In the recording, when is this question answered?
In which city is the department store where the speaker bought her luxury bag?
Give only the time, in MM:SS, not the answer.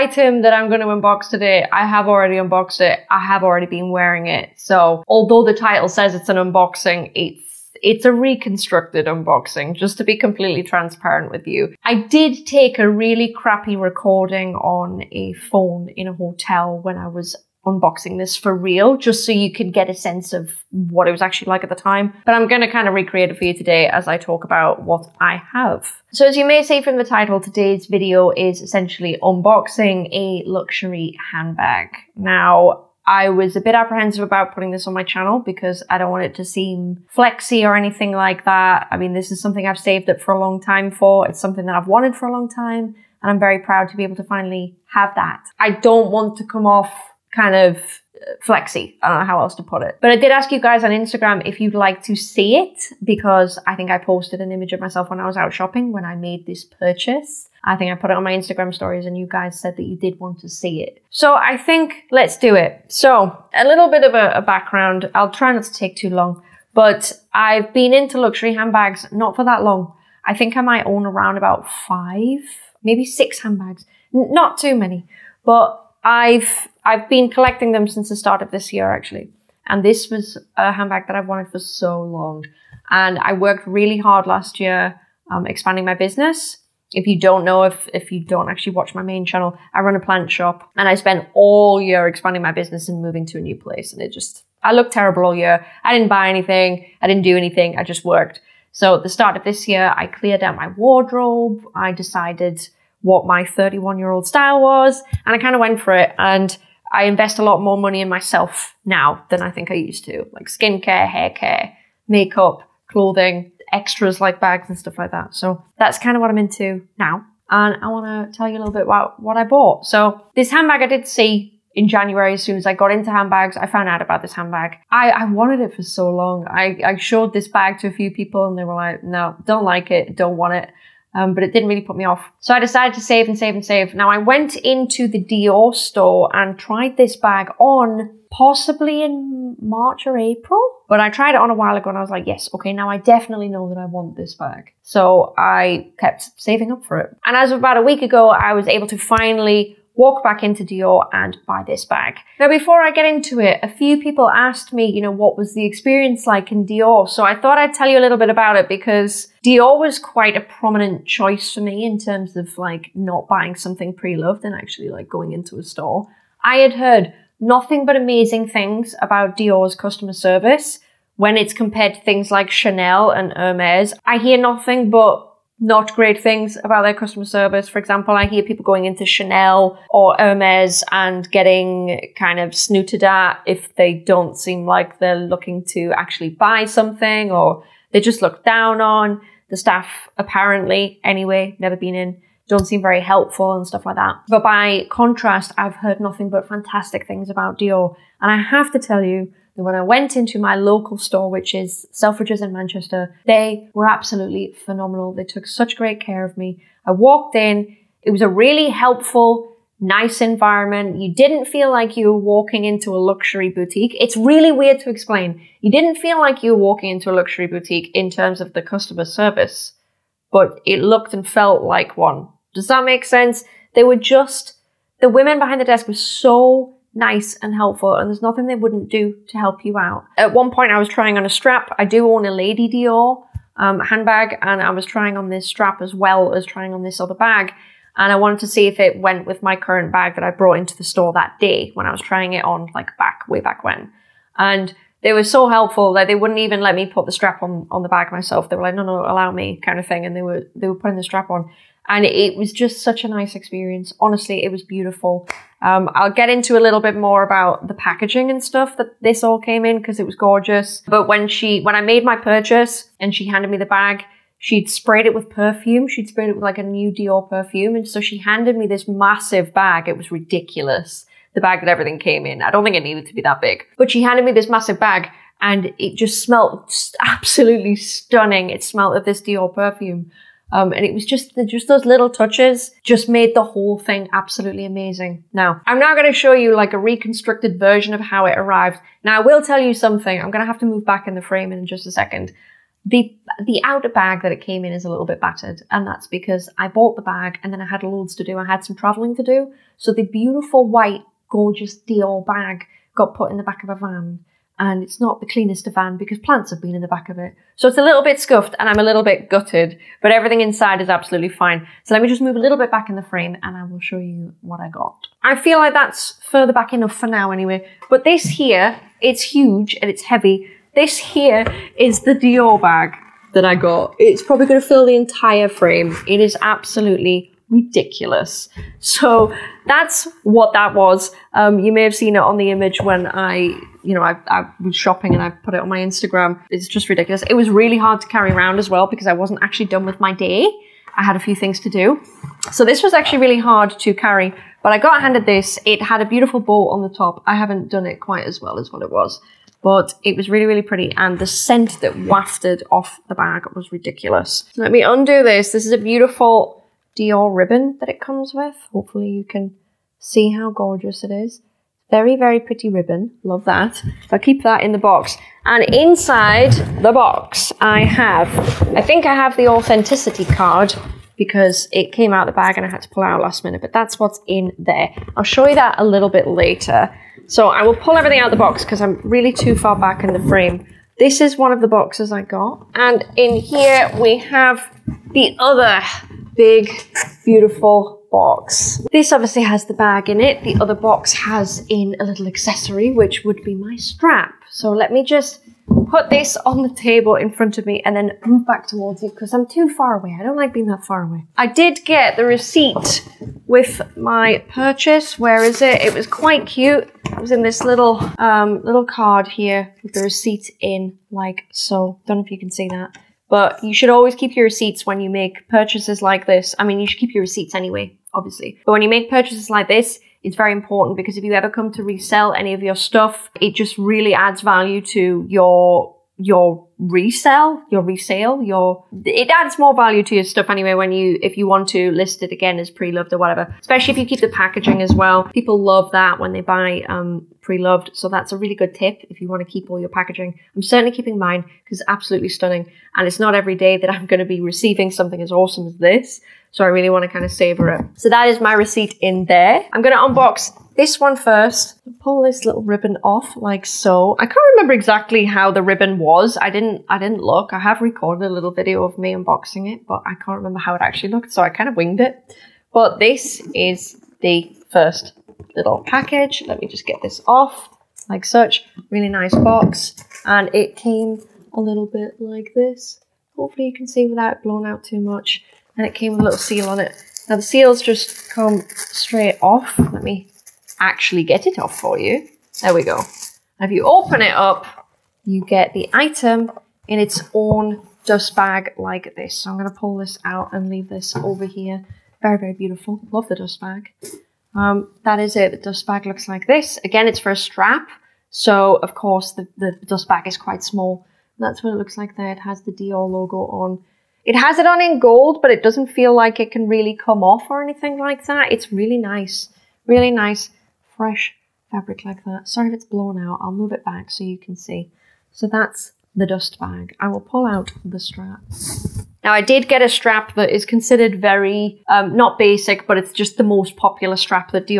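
03:22.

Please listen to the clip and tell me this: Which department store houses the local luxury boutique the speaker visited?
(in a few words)
Selfridges.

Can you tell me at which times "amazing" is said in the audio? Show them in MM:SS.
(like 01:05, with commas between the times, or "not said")
02:47, 04:44.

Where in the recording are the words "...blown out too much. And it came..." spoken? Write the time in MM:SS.
07:54.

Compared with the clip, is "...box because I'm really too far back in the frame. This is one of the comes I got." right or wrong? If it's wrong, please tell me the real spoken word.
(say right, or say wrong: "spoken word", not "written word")
wrong: "boxes", not "comes".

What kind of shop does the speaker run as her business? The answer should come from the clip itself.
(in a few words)
plant shop.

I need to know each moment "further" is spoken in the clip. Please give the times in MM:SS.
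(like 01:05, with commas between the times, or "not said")
05:16.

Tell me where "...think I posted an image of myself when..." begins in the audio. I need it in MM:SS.
00:53.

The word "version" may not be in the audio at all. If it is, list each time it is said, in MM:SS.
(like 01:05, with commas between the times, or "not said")
04:47.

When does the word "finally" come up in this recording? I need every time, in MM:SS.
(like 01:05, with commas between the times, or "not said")
00:44, 02:28.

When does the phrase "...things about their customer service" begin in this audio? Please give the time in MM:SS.
02:56.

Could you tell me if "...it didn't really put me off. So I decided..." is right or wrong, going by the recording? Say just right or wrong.
right.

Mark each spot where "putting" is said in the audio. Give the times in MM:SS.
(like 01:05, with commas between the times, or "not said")
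00:34, 04:10.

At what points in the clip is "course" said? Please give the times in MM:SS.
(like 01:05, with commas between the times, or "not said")
08:18.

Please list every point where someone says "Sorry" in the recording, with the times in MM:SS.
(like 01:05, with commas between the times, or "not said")
08:32.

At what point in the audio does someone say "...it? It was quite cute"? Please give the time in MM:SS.
06:45.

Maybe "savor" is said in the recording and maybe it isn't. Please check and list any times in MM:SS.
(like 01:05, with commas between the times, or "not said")
07:27.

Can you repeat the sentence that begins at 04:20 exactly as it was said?
But when she, when I made my purchase and she handed me the bag, she'd sprayed it with perfume.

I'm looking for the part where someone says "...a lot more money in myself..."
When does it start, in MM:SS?
01:47.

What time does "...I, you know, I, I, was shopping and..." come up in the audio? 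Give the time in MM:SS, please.
05:33.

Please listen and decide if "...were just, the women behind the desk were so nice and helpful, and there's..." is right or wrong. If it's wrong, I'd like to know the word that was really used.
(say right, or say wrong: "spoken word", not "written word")
right.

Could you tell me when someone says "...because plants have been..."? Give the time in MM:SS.
05:05.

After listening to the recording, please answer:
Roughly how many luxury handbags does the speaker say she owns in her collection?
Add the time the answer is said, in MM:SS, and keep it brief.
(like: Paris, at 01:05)
5, at 01:11.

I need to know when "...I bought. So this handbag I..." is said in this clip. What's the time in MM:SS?
01:59.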